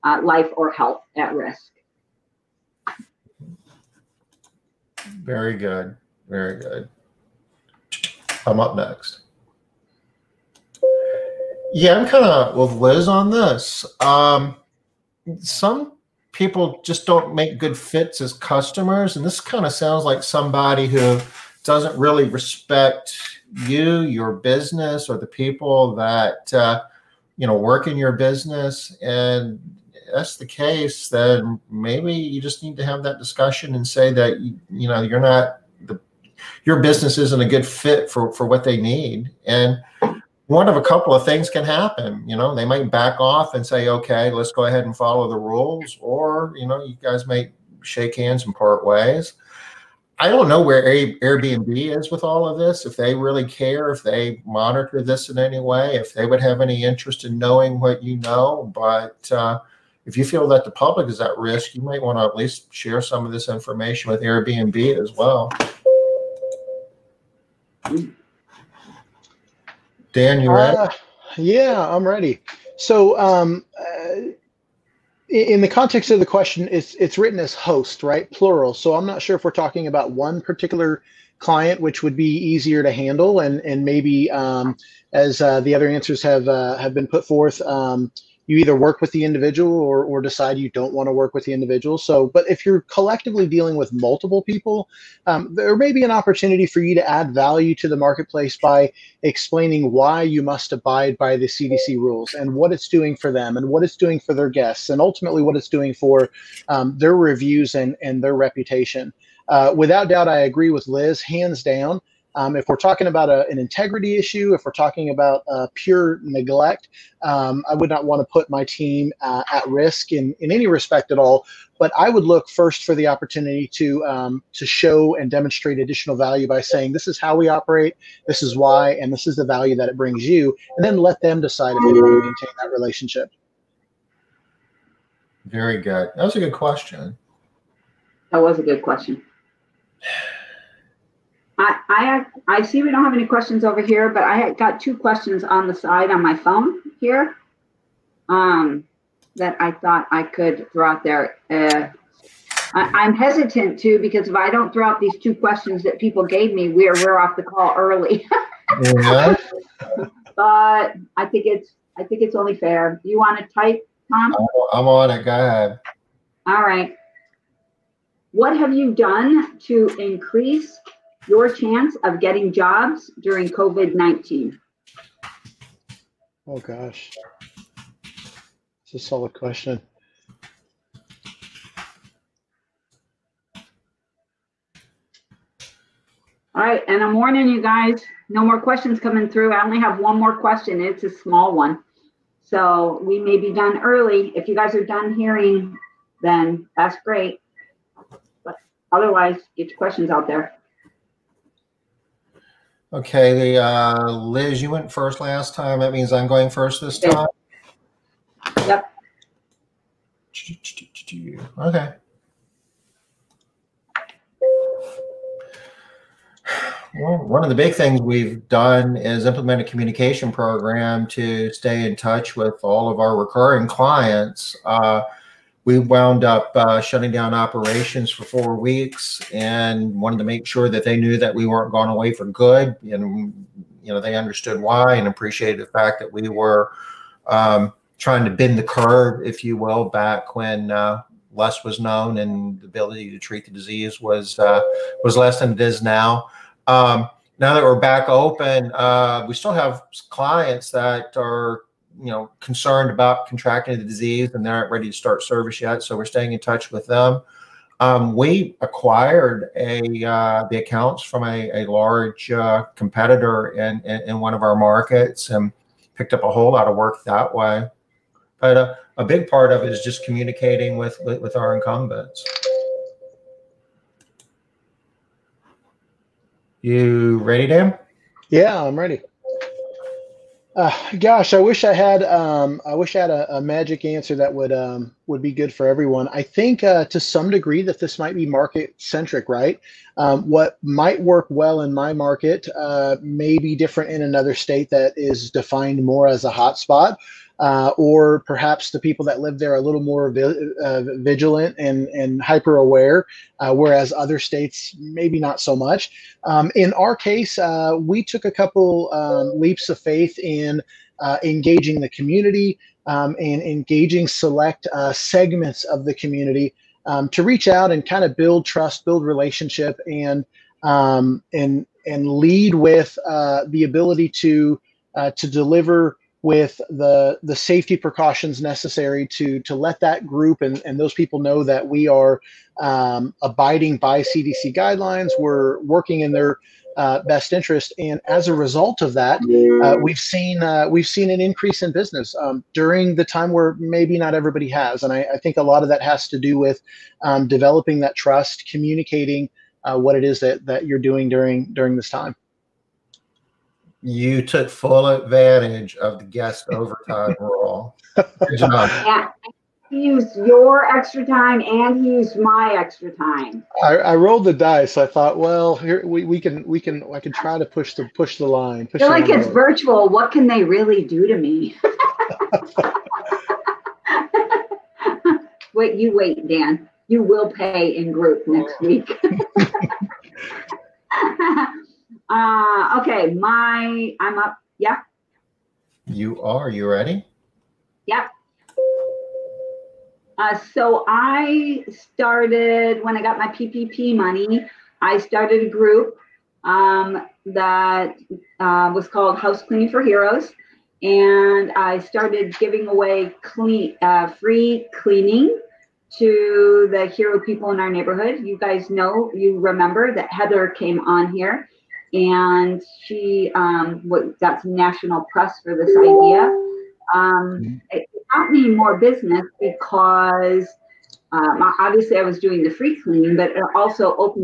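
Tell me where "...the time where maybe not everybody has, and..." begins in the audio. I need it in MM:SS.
05:42.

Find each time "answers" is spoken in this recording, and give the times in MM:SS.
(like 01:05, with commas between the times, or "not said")
01:25, 04:43.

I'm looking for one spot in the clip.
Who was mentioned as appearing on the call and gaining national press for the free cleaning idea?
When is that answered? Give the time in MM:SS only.
06:50.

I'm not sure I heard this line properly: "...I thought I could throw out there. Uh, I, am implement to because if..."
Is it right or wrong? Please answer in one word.
wrong.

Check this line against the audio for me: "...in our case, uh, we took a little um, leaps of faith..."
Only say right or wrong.
wrong.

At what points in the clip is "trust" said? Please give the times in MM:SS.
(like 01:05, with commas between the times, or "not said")
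05:18, 05:47.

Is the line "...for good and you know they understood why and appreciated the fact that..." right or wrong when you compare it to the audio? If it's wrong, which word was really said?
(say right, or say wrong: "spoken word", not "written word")
right.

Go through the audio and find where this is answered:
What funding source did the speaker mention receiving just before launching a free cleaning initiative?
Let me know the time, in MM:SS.
06:33.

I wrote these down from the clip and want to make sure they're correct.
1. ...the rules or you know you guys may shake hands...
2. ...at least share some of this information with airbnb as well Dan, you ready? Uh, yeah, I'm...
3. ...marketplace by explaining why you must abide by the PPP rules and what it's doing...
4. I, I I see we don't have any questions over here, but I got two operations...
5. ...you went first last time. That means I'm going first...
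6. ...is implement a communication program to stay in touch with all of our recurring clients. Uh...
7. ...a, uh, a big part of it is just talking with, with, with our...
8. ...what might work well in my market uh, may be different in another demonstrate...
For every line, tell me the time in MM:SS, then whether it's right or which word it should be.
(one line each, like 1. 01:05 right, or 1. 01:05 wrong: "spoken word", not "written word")
1. 00:45 right
2. 01:02 right
3. 01:37 wrong: "CDC", not "PPP"
4. 02:21 wrong: "questions", not "operations"
5. 03:24 right
6. 03:38 right
7. 04:28 wrong: "communicating", not "talking"
8. 04:50 wrong: "state", not "demonstrate".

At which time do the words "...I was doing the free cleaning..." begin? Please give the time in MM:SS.
07:01.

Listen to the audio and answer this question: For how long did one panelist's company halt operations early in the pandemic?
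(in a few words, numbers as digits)
four weeks.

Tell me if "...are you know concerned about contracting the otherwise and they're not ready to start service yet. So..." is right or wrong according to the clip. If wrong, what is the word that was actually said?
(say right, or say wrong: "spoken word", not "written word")
wrong: "disease", not "otherwise".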